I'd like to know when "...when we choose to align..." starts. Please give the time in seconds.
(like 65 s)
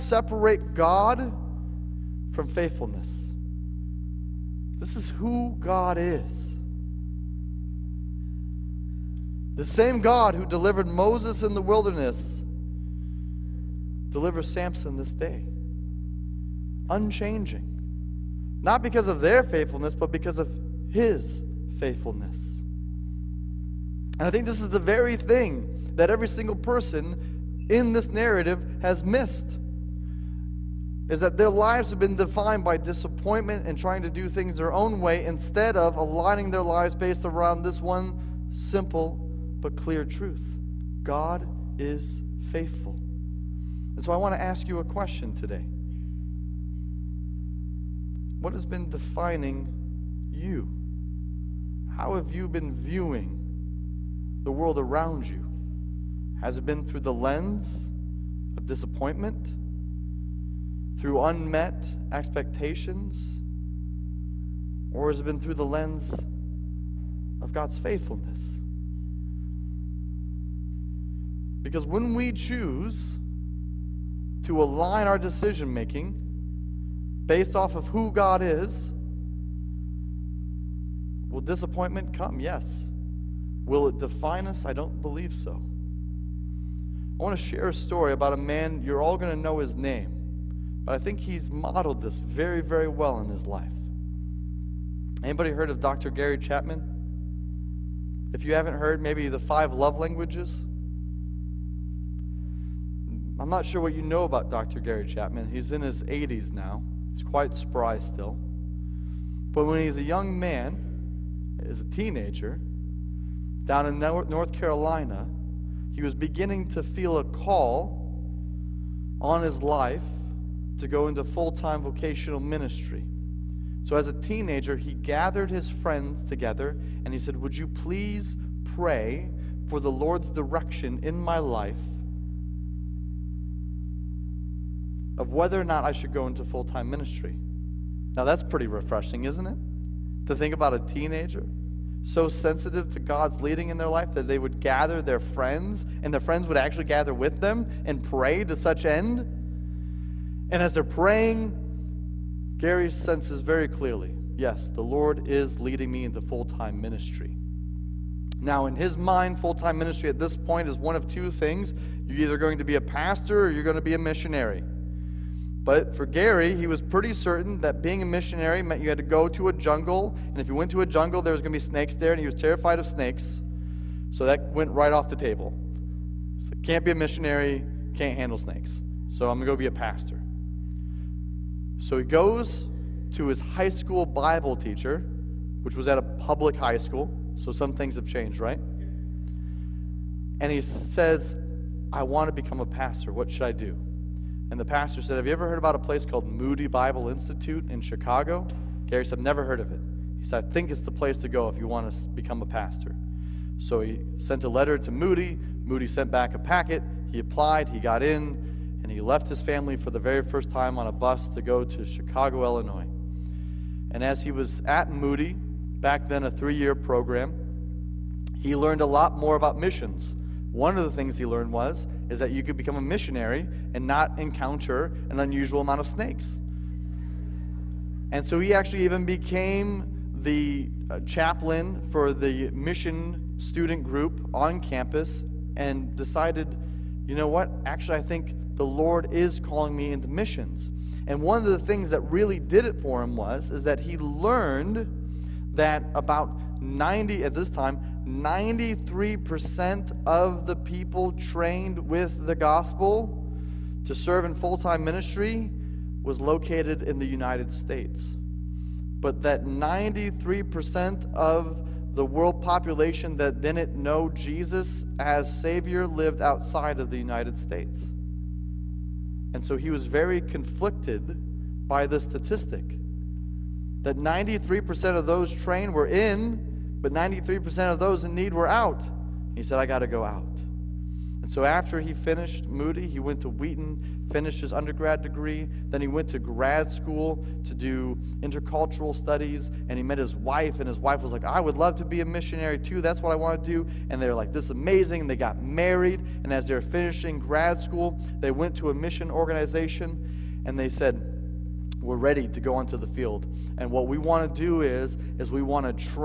71 s.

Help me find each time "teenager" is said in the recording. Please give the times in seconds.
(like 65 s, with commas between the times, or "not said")
111 s, 124 s, 140 s.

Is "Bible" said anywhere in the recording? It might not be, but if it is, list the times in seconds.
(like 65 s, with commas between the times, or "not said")
184 s, 196 s.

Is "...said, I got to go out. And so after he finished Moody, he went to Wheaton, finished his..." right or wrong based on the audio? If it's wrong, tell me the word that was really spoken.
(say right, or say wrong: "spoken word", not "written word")
right.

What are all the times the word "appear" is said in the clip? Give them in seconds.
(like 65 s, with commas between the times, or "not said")
not said.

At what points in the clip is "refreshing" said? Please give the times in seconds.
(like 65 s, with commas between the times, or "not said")
138 s.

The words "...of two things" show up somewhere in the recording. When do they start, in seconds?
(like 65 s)
160 s.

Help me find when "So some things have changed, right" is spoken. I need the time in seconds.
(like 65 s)
187 s.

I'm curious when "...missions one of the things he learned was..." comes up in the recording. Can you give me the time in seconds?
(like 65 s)
219 s.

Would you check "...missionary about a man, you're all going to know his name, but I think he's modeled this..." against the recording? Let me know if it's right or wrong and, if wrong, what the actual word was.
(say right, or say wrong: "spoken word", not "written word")
wrong: "story", not "missionary".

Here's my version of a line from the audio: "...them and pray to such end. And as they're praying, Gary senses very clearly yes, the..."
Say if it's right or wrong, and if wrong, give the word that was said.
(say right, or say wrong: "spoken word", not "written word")
right.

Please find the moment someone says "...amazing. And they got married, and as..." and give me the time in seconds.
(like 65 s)
294 s.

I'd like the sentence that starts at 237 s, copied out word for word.
Actually, I think the Lord is calling me into missions.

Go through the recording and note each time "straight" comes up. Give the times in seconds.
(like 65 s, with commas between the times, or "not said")
not said.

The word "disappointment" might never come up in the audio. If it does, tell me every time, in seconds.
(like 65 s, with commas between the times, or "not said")
32 s, 58 s, 81 s.